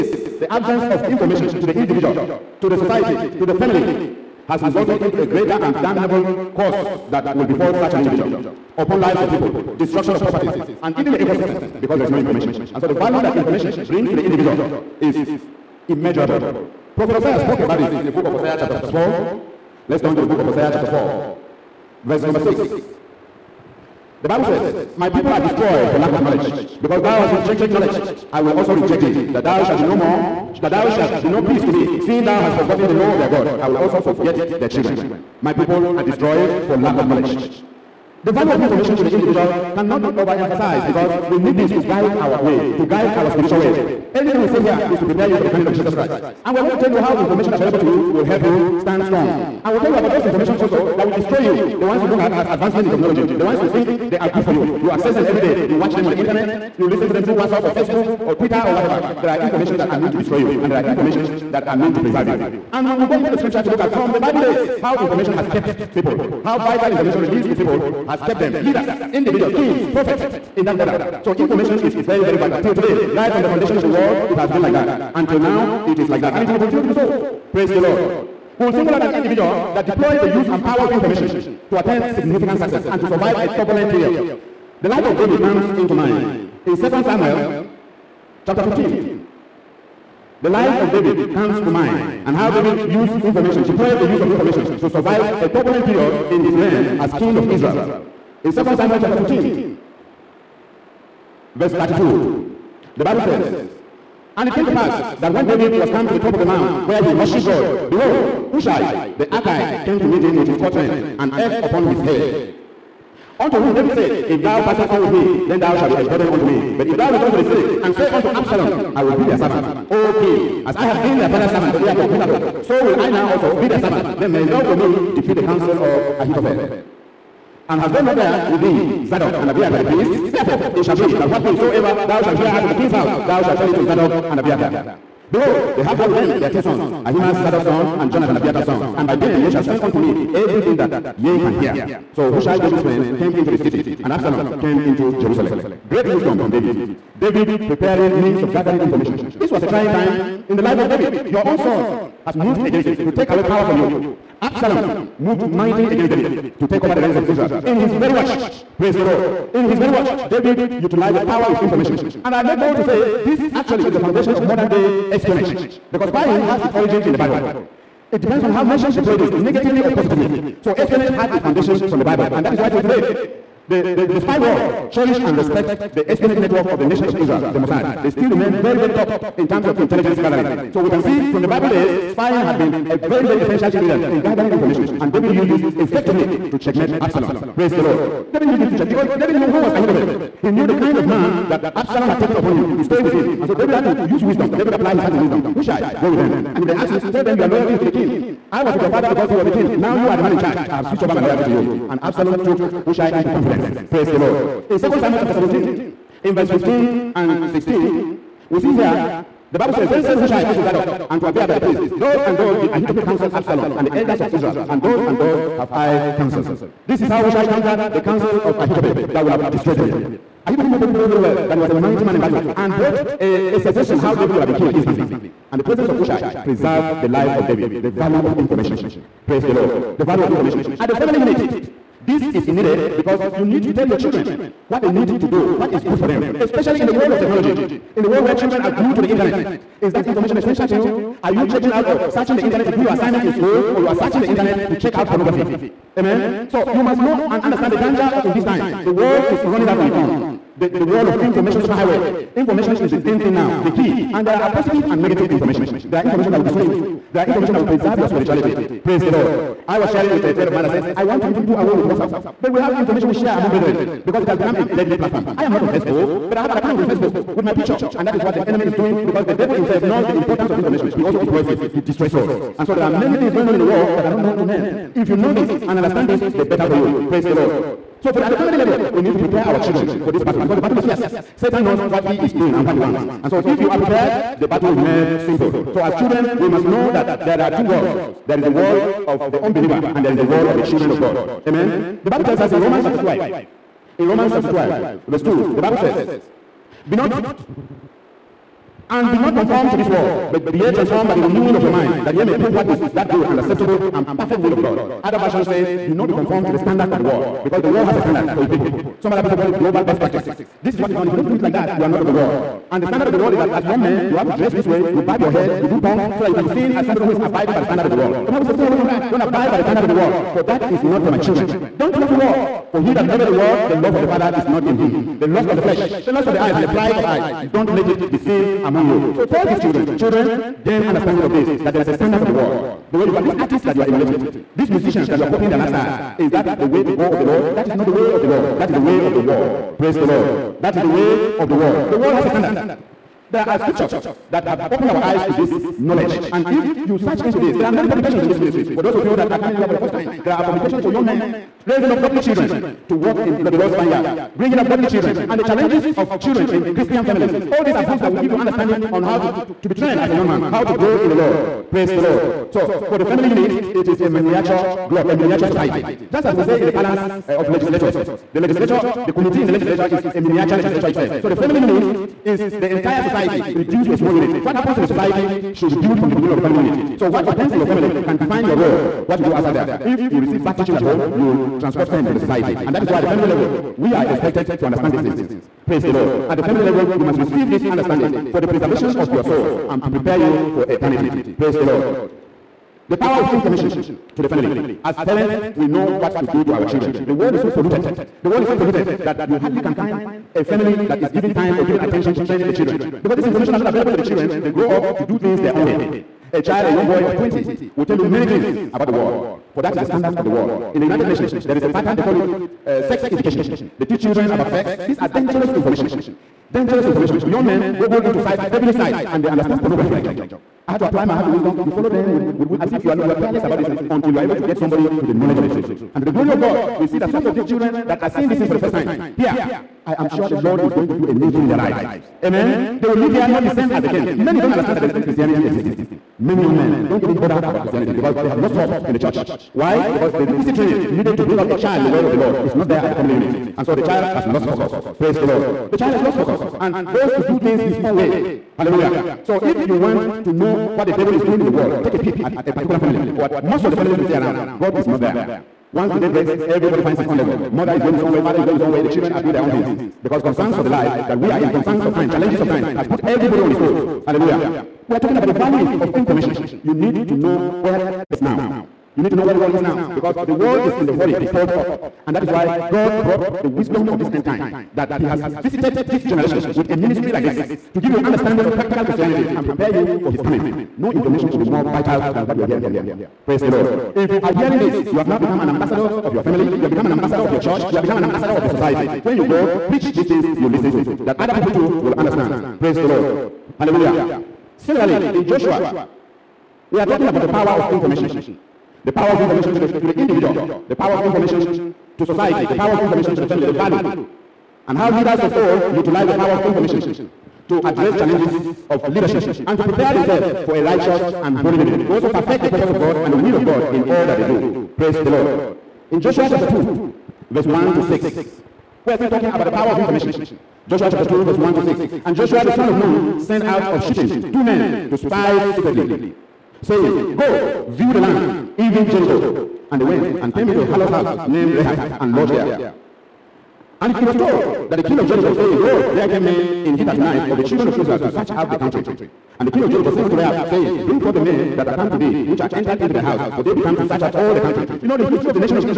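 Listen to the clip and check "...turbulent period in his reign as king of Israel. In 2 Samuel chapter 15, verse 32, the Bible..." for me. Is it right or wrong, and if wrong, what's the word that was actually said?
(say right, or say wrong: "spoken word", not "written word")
right.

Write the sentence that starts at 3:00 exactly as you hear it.
So we can see from the Bible days, spying had been a very, very essential ingredient in gathering information.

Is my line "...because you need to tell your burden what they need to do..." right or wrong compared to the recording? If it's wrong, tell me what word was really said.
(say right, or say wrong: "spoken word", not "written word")
wrong: "children", not "burden".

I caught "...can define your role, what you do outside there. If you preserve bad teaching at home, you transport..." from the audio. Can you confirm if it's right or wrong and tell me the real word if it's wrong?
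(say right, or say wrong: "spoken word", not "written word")
wrong: "receive", not "preserve".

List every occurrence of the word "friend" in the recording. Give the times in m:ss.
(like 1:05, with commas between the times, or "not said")
2:22, 4:20.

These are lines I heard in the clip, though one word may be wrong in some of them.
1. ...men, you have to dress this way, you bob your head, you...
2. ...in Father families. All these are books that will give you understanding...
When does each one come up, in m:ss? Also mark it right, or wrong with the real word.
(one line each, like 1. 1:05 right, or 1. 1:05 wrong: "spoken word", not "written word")
1. 5:13 right
2. 5:56 wrong: "Christian", not "Father".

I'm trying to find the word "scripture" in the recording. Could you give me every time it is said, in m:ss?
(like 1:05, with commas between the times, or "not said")
1:03, 5:43.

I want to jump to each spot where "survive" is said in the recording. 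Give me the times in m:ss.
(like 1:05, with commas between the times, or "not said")
1:23, 1:34.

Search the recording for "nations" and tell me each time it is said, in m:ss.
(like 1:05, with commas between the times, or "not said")
2:48, 2:56, 6:51.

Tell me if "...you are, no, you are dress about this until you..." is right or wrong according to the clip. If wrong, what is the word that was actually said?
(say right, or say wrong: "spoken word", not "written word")
wrong: "careless", not "dress".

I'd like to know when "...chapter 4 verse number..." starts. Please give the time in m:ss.
0:20.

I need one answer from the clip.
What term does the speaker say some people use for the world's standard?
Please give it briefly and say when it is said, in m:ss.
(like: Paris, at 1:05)
global best practice, at 5:09.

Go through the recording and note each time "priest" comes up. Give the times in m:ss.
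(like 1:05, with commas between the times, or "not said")
0:31, 2:09, 3:31.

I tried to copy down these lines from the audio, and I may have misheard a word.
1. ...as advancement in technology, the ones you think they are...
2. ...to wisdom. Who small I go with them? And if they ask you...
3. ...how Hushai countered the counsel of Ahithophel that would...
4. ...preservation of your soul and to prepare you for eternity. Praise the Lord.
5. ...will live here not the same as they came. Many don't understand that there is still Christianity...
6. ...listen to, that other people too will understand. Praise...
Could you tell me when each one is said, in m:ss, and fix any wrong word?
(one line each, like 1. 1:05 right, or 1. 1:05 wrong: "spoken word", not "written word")
1. 0:52 right
2. 3:15 wrong: "shall", not "small"
3. 3:37 right
4. 6:28 right
5. 7:12 right
6. 8:10 right.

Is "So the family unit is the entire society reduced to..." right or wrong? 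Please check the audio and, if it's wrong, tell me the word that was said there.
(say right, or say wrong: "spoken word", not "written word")
right.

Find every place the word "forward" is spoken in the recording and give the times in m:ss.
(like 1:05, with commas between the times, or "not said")
not said.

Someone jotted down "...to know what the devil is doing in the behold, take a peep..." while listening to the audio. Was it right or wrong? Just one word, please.
wrong.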